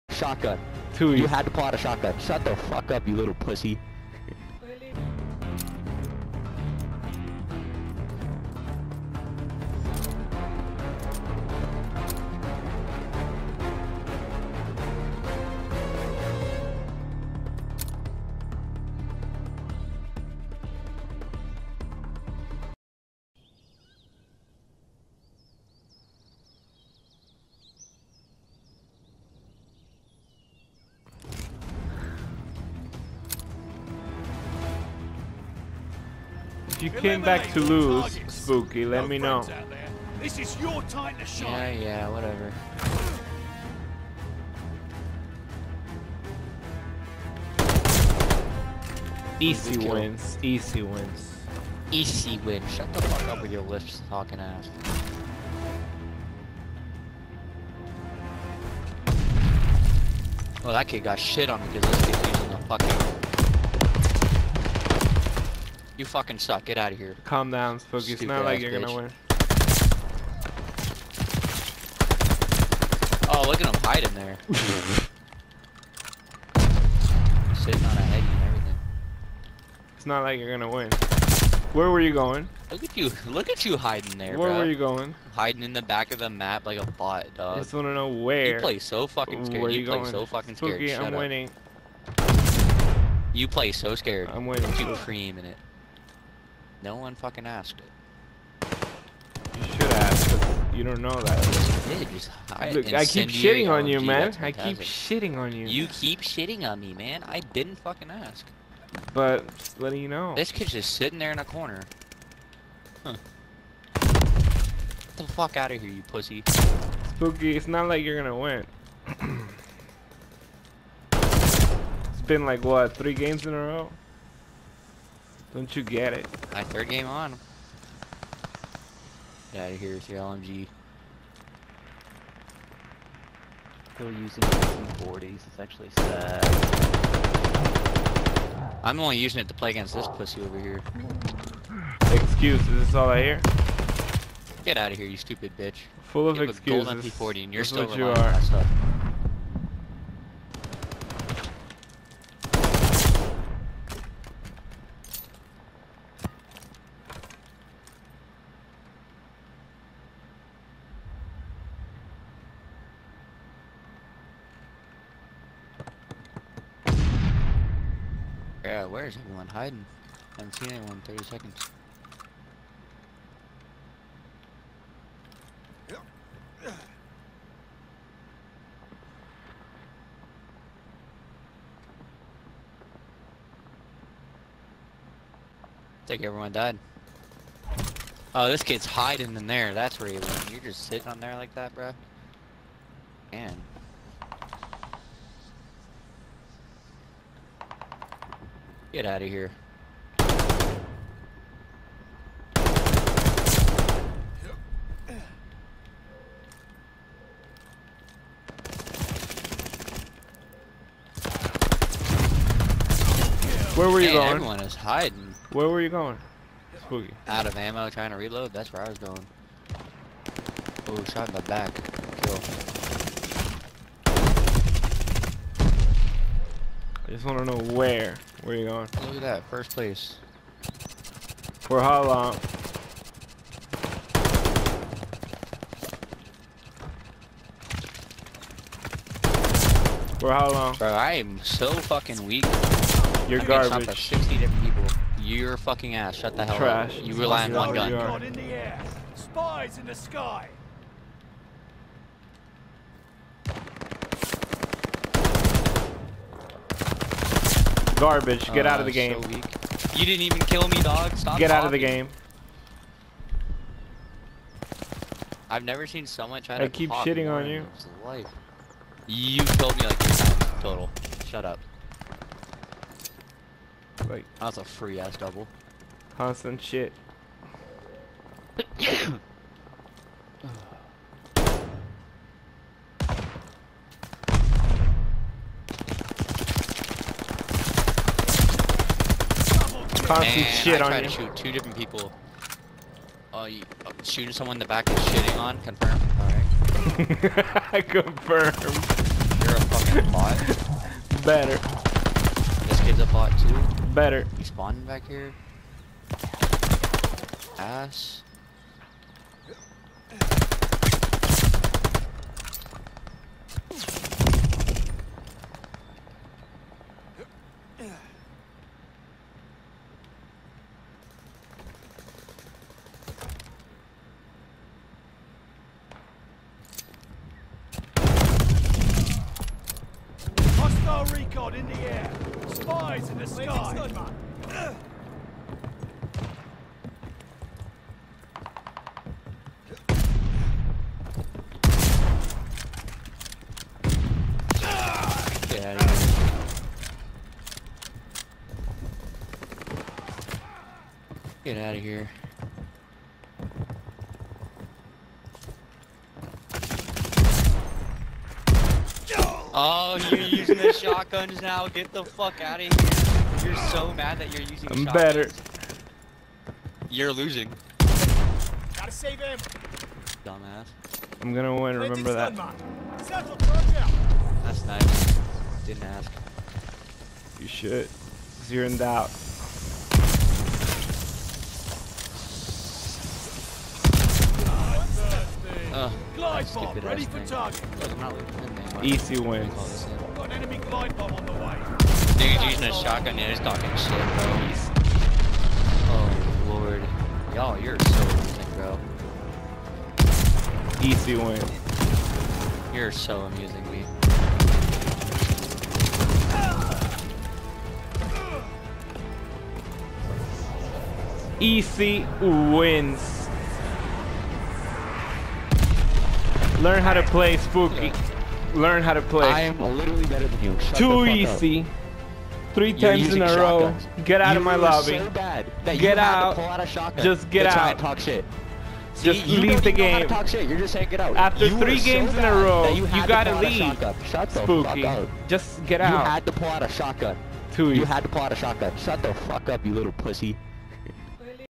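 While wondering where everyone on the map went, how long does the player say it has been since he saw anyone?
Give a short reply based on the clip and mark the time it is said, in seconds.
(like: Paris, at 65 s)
30 seconds, at 171 s.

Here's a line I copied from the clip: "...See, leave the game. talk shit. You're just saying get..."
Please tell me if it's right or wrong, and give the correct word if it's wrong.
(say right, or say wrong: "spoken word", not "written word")
right.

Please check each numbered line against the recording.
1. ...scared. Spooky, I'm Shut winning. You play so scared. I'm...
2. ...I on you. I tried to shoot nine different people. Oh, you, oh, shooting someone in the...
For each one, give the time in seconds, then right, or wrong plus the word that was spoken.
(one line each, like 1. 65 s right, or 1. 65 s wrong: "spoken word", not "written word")
1. 90 s right
2. 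290 s wrong: "two", not "nine".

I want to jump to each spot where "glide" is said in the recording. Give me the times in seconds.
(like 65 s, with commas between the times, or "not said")
386 s, 390 s.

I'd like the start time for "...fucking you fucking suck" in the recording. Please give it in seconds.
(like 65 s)
62 s.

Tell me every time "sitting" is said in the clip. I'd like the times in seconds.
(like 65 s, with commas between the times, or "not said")
77 s, 110 s, 190 s.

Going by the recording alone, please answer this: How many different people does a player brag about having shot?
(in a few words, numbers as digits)
60.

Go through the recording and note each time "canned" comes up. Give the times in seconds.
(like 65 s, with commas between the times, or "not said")
not said.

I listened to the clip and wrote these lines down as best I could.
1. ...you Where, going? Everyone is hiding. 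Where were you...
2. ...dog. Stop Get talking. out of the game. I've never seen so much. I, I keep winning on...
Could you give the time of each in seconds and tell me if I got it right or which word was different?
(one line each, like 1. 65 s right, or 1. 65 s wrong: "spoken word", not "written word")
1. 214 s wrong: "Man", not "Where"
2. 260 s wrong: "shitting", not "winning".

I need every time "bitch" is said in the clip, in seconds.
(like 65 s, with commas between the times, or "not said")
68 s, 145 s.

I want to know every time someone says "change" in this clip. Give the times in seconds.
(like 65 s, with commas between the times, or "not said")
not said.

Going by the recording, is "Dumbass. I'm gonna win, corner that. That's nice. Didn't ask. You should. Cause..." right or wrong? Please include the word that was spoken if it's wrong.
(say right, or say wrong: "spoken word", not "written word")
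wrong: "remember", not "corner".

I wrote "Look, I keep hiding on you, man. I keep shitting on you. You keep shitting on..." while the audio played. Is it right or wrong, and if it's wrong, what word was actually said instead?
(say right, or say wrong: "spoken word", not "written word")
wrong: "shitting", not "hiding".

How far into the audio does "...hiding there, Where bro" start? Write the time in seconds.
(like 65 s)
83 s.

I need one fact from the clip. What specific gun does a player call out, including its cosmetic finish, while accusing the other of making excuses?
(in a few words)
Golden P40.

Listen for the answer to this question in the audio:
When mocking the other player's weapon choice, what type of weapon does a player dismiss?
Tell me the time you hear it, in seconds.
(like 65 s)
130 s.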